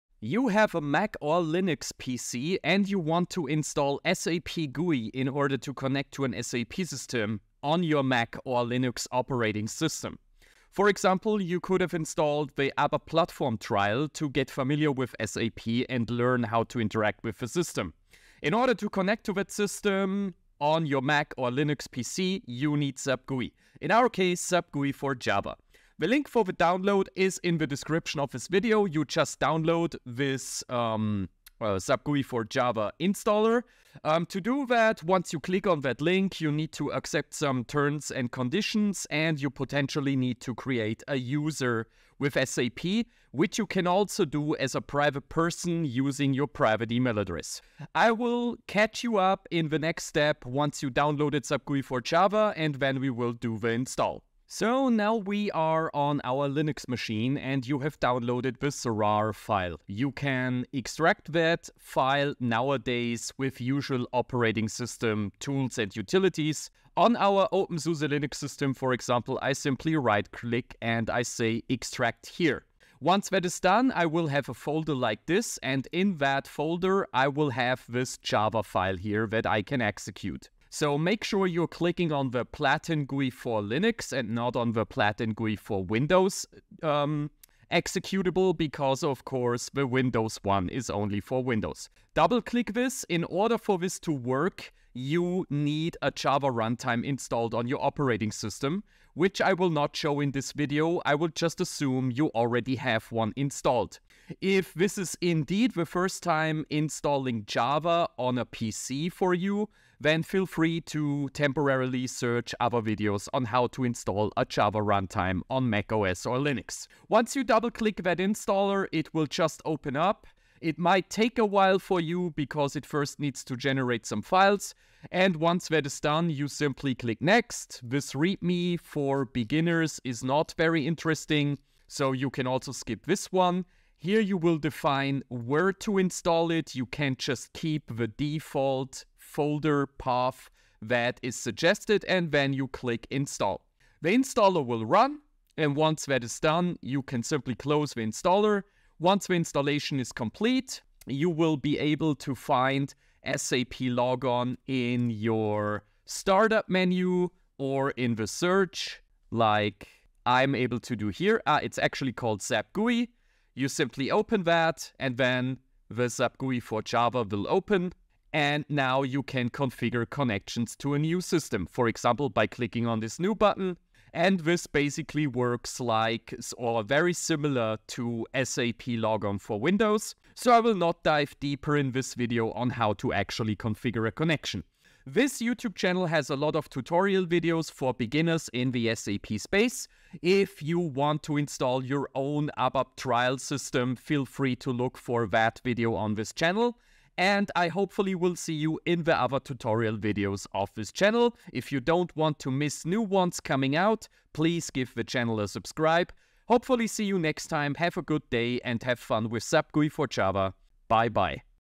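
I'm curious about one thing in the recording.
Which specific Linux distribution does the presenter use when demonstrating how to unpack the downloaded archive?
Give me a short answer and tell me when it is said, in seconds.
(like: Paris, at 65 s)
OpenSUSE, at 67 s.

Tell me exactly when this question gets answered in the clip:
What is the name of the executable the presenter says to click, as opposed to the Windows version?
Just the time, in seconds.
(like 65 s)
82 s.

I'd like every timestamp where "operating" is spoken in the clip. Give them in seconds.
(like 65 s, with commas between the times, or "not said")
9 s, 64 s, 97 s.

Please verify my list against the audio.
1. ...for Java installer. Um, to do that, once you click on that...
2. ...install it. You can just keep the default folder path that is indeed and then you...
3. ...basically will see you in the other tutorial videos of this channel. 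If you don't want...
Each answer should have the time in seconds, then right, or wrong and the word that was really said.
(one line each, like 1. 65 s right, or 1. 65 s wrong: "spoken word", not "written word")
1. 32 s right
2. 135 s wrong: "suggested", not "indeed"
3. 197 s wrong: "hopefully", not "basically".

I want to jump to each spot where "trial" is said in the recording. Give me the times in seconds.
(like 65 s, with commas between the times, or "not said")
13 s, 192 s.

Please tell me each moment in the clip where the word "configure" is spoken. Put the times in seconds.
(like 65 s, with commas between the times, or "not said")
169 s, 183 s.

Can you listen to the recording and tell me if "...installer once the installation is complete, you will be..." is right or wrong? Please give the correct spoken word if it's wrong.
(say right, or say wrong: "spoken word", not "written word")
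right.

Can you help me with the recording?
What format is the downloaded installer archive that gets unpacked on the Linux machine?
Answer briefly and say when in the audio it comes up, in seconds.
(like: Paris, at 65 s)
RAR, at 58 s.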